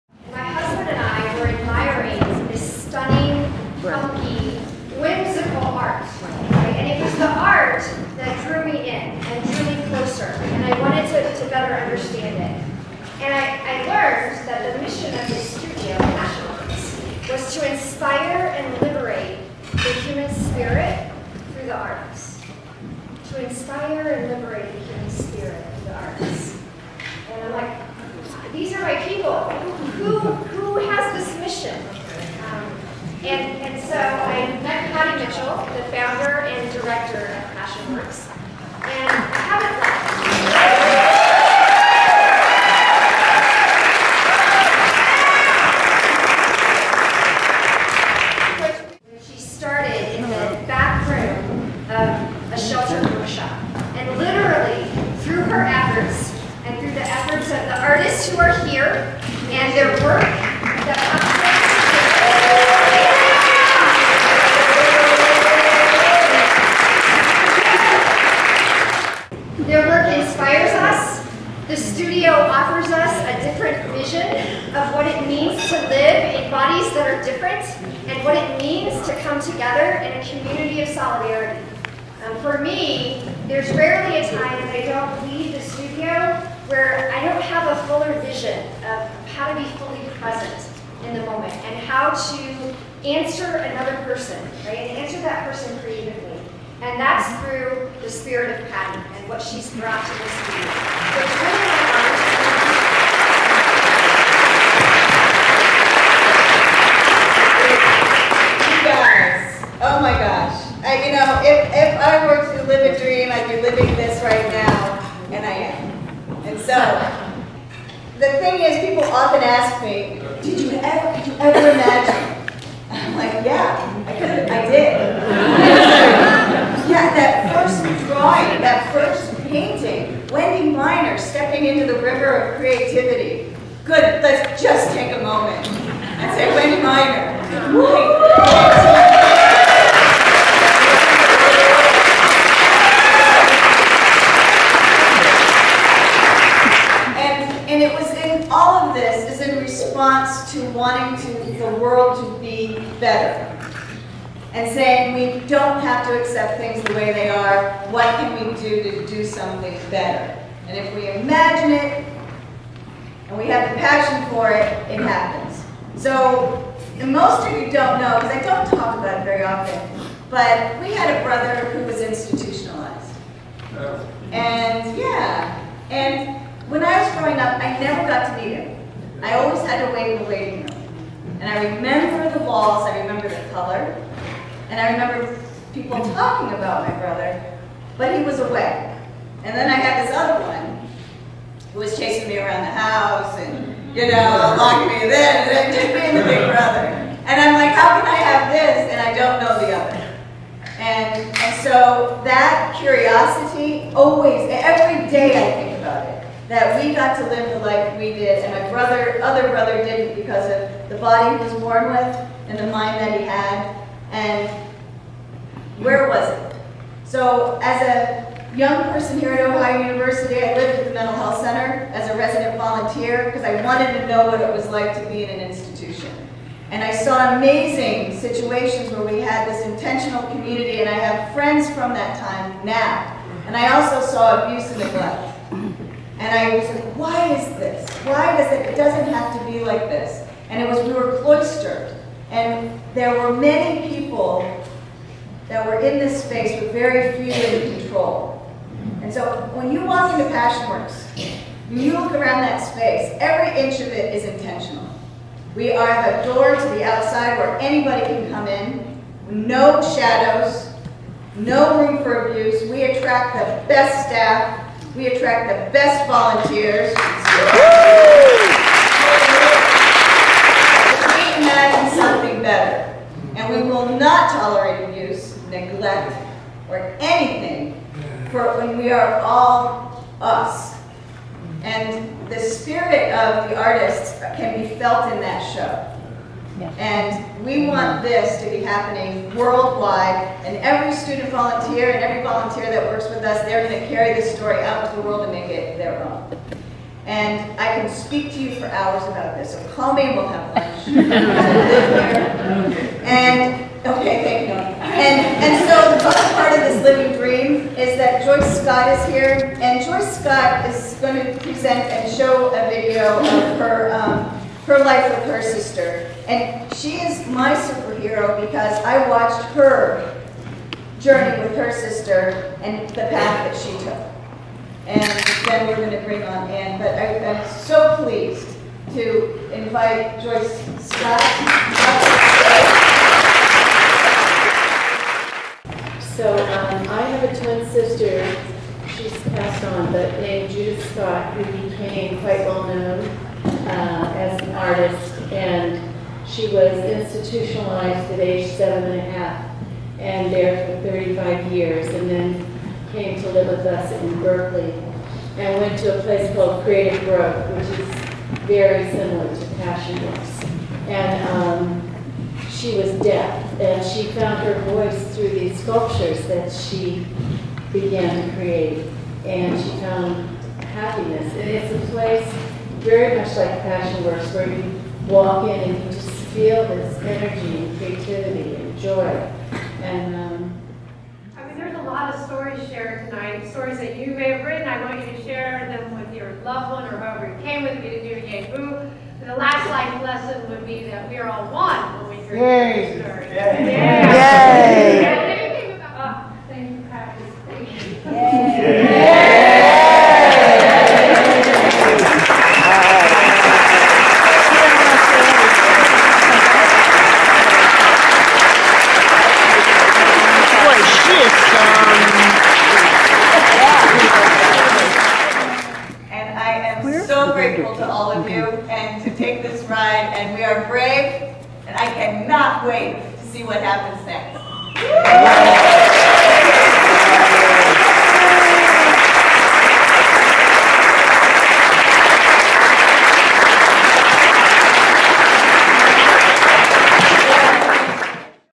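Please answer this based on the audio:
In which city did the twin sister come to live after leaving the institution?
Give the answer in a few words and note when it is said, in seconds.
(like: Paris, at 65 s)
Berkeley, at 354 s.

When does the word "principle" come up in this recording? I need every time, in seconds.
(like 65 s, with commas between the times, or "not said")
not said.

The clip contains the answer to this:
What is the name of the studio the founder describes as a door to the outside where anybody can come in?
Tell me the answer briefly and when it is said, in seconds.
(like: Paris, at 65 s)
PassionWorks, at 250 s.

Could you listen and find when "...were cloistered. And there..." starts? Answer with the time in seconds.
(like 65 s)
240 s.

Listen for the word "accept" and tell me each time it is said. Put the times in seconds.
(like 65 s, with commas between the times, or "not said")
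156 s.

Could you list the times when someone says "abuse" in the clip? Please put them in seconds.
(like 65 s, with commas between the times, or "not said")
234 s, 262 s, 274 s.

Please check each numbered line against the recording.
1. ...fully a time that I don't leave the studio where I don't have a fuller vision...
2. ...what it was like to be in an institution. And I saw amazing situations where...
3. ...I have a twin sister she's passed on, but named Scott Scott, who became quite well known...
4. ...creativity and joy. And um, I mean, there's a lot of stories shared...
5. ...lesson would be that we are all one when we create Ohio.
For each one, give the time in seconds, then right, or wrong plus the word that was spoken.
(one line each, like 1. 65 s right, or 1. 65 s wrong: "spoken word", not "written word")
1. 83 s wrong: "rarely", not "fully"
2. 224 s right
3. 336 s wrong: "Judith", not "Scott"
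4. 377 s right
5. 390 s wrong: "Yay", not "Ohio".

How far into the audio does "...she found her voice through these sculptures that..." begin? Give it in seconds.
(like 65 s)
363 s.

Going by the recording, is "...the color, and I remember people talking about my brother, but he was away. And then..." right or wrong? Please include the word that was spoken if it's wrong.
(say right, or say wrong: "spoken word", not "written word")
right.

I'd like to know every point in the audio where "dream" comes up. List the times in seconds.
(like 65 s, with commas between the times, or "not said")
113 s, 307 s.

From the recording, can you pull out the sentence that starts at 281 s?
And the spirit of the artists can be felt in that show.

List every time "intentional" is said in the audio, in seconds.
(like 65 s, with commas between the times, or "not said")
229 s, 254 s.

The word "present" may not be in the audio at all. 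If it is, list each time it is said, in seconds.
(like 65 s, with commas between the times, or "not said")
90 s, 311 s.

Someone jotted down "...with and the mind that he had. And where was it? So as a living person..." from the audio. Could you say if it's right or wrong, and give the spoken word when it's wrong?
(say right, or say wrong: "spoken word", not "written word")
wrong: "young", not "living".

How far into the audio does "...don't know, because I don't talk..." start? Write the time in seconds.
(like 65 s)
167 s.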